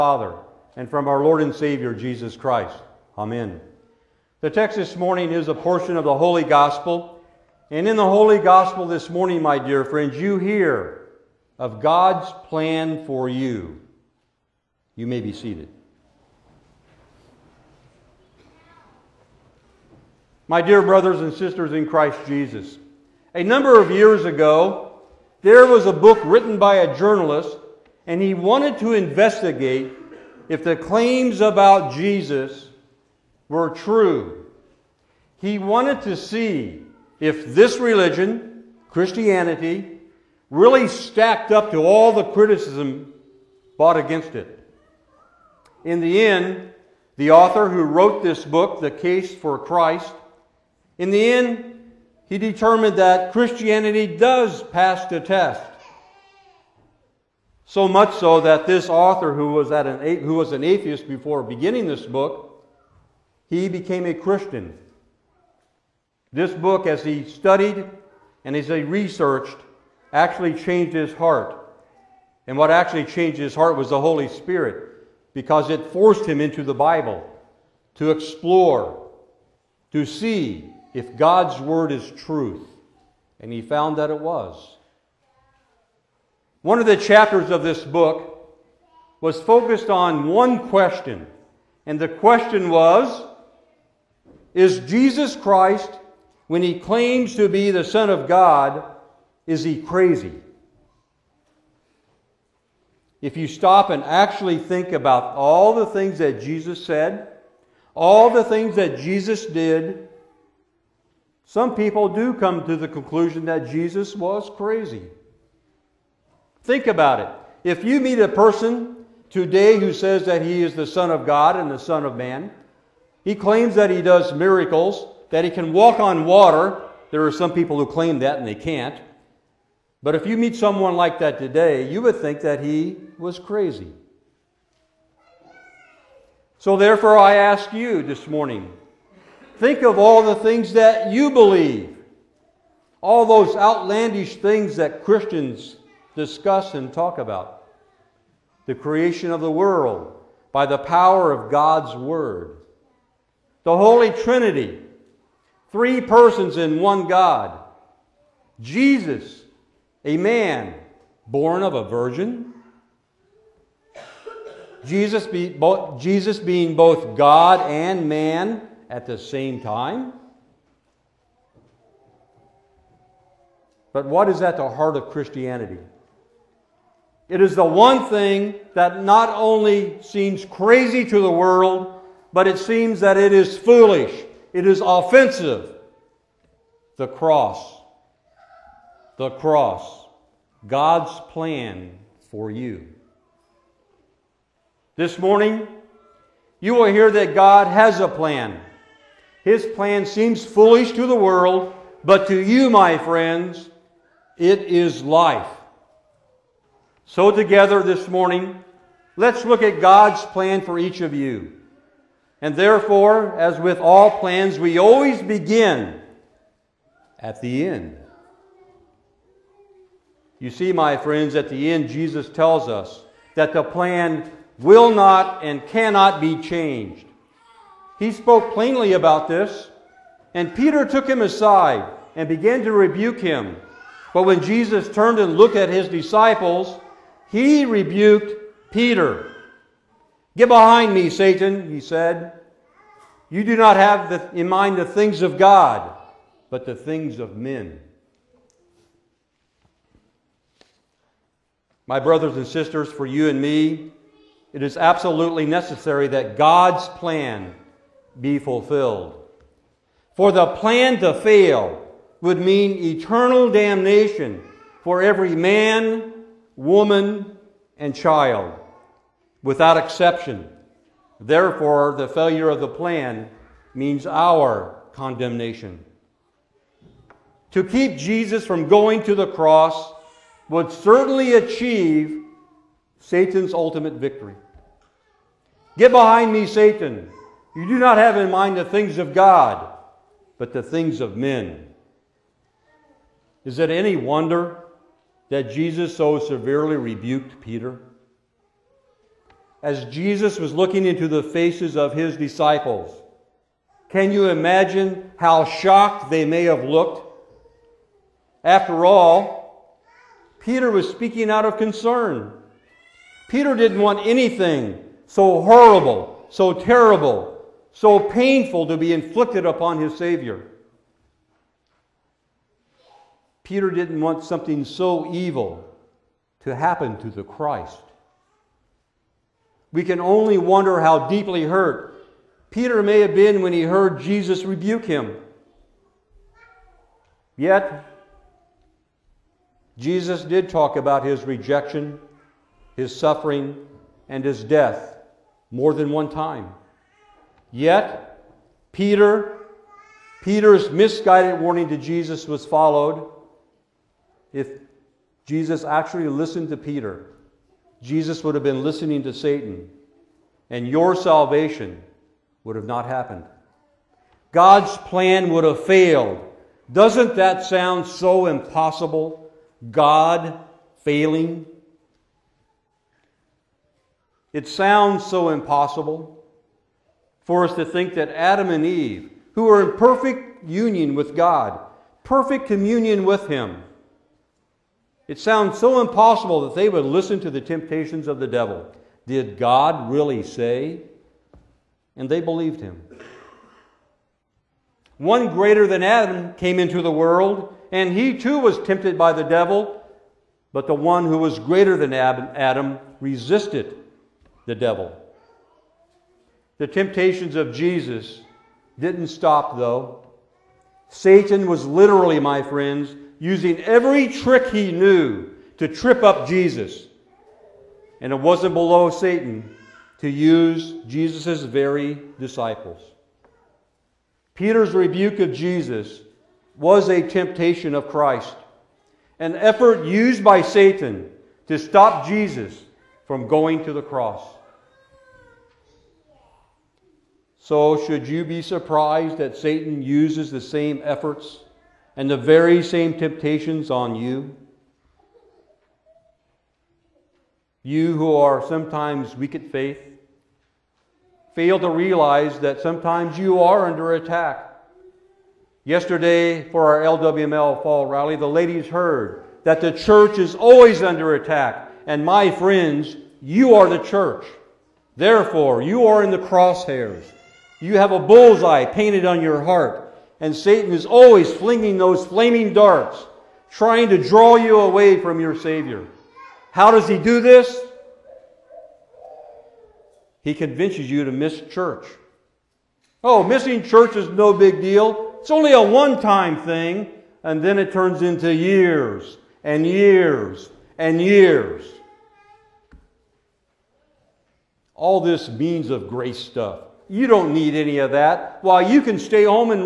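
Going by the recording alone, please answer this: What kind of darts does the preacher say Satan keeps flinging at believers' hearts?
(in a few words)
Flaming darts.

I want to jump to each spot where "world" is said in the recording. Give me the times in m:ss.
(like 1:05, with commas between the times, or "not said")
2:29, 3:01, 3:21, 6:36.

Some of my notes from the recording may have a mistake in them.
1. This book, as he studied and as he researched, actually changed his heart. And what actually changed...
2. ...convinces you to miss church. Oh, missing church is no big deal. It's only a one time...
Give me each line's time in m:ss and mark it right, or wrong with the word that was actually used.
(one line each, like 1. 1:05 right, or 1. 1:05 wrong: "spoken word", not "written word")
1. 1:06 right
2. 8:00 right.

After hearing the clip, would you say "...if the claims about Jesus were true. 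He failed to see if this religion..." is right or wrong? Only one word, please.
wrong.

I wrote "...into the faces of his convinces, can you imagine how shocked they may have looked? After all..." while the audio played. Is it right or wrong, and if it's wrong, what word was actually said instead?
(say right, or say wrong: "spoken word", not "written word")
wrong: "disciples", not "convinces".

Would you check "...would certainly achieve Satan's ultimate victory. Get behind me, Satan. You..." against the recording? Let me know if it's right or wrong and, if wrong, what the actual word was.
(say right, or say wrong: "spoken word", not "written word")
right.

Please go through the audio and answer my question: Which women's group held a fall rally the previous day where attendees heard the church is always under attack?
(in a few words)
LWML.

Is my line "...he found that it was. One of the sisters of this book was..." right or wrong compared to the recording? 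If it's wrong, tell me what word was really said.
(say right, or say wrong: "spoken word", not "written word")
wrong: "chapters", not "sisters".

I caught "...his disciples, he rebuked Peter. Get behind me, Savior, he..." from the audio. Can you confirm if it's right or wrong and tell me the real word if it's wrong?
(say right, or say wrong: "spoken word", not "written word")
wrong: "Satan", not "Savior".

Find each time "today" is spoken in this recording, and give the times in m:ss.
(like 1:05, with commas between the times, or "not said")
1:59, 2:11.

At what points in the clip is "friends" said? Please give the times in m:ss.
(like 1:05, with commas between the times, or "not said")
0:09, 3:22, 3:40, 6:52, 7:42.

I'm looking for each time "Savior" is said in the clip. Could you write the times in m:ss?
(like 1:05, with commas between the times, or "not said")
0:01, 5:19, 7:55.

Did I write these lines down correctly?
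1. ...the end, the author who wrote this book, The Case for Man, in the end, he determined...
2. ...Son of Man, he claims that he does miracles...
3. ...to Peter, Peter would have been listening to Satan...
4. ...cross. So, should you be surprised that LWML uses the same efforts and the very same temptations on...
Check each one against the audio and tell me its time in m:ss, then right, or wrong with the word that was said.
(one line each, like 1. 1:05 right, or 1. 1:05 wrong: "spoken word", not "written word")
1. 0:45 wrong: "Christ", not "Man"
2. 2:01 right
3. 5:56 wrong: "Jesus", not "Peter"
4. 7:13 wrong: "Satan", not "LWML".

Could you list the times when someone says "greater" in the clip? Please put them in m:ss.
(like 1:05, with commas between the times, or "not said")
6:35, 6:41.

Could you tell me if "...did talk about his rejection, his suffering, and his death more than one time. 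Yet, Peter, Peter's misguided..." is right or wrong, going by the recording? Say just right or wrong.
right.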